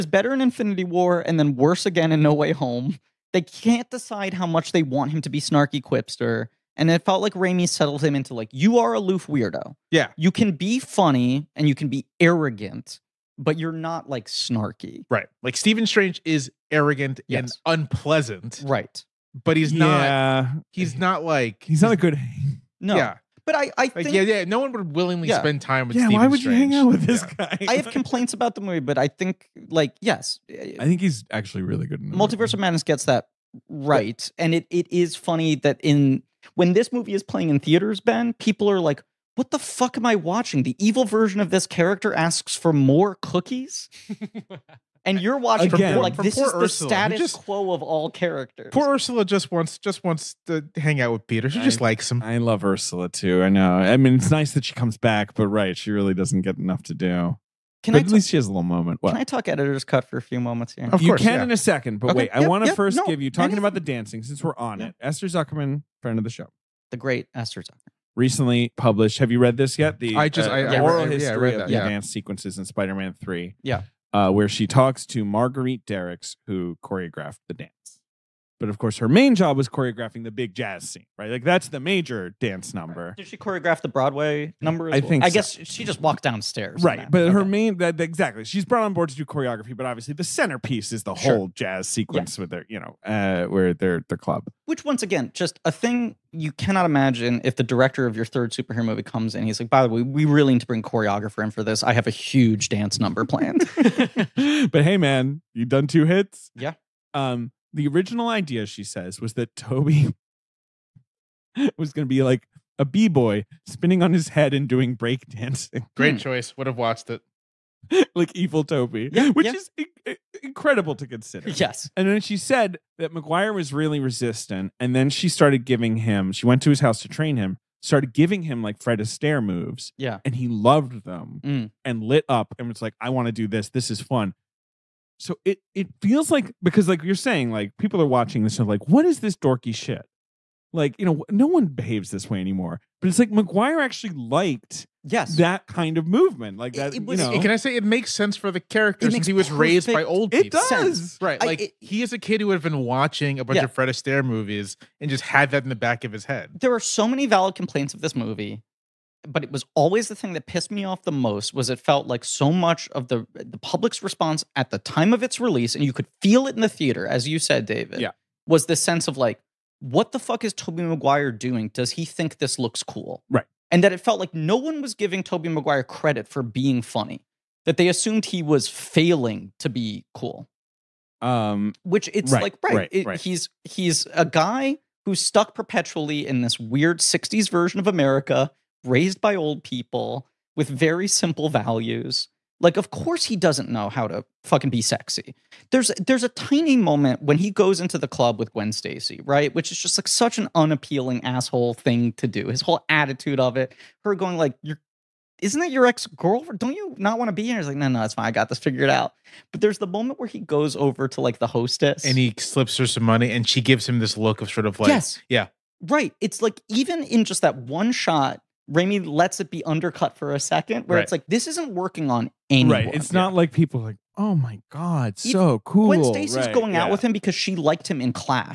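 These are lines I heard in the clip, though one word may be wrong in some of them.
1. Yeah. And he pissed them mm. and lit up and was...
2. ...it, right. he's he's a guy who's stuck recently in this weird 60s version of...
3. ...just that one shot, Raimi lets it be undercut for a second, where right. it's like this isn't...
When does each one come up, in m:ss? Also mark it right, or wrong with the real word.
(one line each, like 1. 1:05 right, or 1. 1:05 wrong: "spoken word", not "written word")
1. 2:09 wrong: "loved", not "pissed"
2. 3:02 wrong: "perpetually", not "recently"
3. 3:37 right.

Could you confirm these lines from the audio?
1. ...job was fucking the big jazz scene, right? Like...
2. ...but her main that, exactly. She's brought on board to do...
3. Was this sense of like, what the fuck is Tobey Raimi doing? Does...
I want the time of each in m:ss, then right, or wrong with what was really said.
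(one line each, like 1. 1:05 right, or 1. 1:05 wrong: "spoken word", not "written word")
1. 1:19 wrong: "choreographing", not "fucking"
2. 1:27 right
3. 2:48 wrong: "Maguire", not "Raimi".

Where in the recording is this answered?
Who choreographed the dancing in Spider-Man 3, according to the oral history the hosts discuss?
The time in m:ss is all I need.
1:15.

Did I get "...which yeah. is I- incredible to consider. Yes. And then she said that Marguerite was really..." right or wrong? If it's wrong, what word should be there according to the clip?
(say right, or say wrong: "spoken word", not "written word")
wrong: "Maguire", not "Marguerite".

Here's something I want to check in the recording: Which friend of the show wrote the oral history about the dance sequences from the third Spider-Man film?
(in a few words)
Esther Zuckerman.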